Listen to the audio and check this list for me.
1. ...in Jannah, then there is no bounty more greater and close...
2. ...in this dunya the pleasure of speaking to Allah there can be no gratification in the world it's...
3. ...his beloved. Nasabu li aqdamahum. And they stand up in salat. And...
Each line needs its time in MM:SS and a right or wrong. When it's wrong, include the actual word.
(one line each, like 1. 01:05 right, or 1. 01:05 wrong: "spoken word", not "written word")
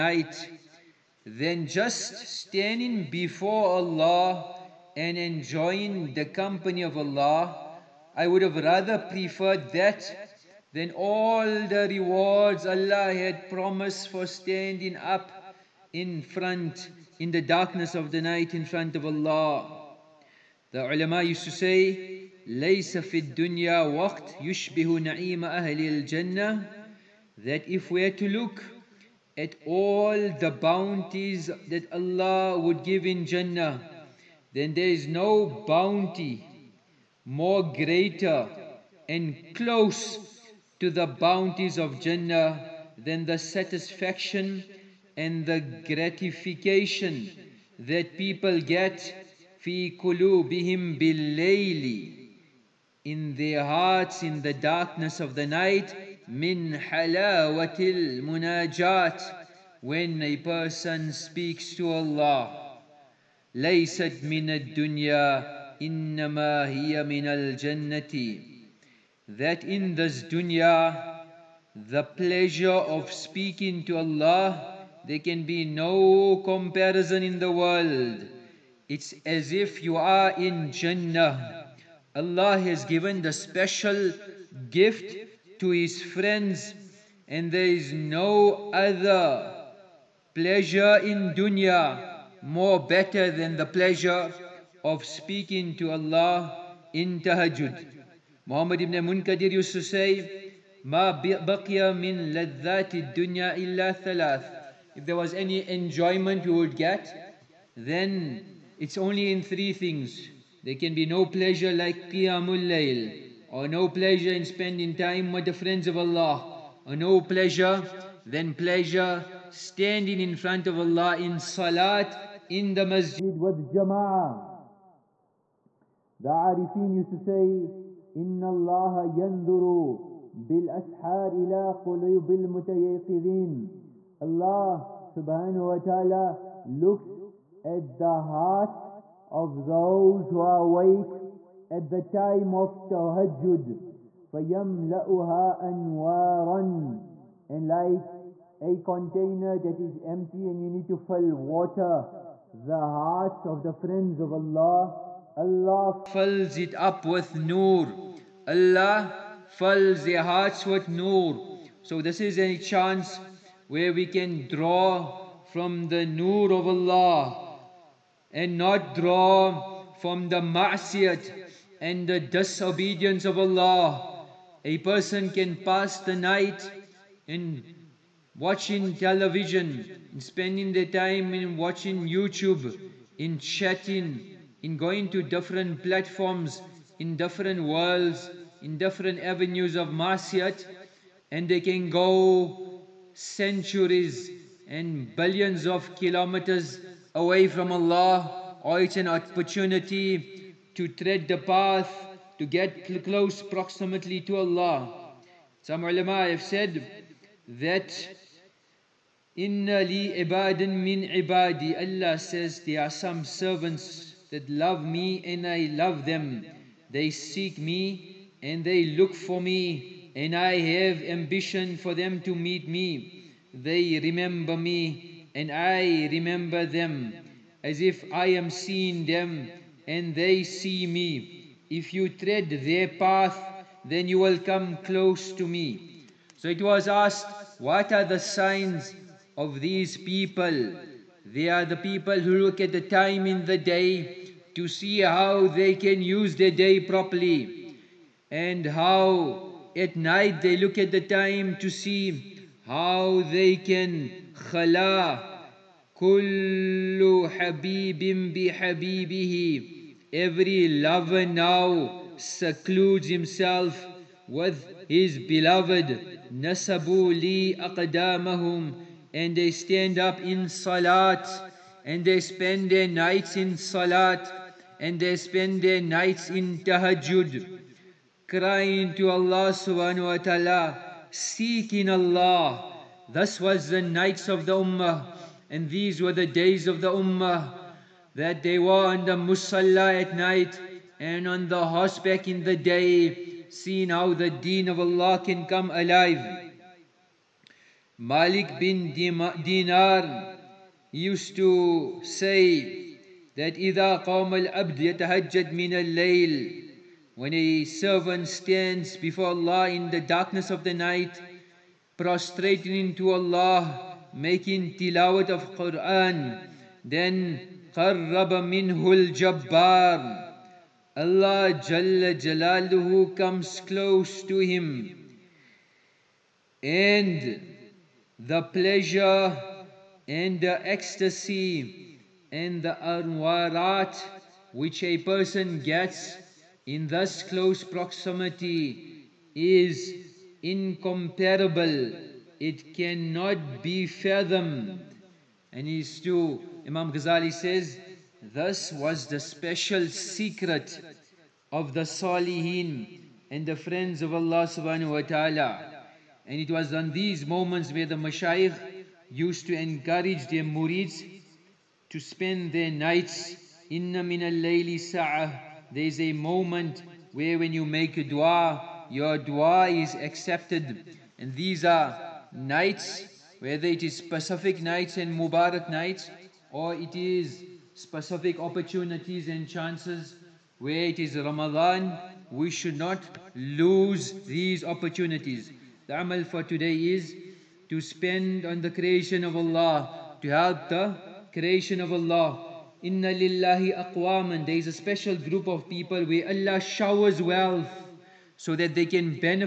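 1. 00:33 right
2. 01:09 wrong: "comparison", not "gratification"
3. 04:24 right.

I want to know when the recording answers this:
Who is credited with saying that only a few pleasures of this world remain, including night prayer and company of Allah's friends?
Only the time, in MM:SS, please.
01:38.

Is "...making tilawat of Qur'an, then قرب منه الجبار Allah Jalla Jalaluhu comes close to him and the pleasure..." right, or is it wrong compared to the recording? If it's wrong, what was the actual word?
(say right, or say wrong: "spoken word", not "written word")
right.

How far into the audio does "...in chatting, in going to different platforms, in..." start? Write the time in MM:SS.
03:03.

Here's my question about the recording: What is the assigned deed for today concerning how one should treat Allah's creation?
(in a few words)
Spend on the creation.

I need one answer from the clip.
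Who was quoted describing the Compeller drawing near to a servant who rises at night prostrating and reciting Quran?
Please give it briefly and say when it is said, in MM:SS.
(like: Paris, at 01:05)
Malik bin Dinar, at 04:57.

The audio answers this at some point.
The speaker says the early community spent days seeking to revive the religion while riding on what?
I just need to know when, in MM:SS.
04:51.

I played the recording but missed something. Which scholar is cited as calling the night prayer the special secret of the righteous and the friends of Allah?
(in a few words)
Imam Ghazali.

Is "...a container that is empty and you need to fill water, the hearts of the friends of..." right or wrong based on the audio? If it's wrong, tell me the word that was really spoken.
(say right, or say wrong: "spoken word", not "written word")
right.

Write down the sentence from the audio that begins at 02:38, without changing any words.
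Allah fills their hearts with nur.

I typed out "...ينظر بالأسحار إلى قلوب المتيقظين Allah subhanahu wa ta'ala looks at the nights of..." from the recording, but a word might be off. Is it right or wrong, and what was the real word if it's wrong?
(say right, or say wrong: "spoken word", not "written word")
wrong: "hearts", not "nights".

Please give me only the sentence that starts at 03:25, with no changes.
Some ulama have said that Inna li ibadin min ibadi.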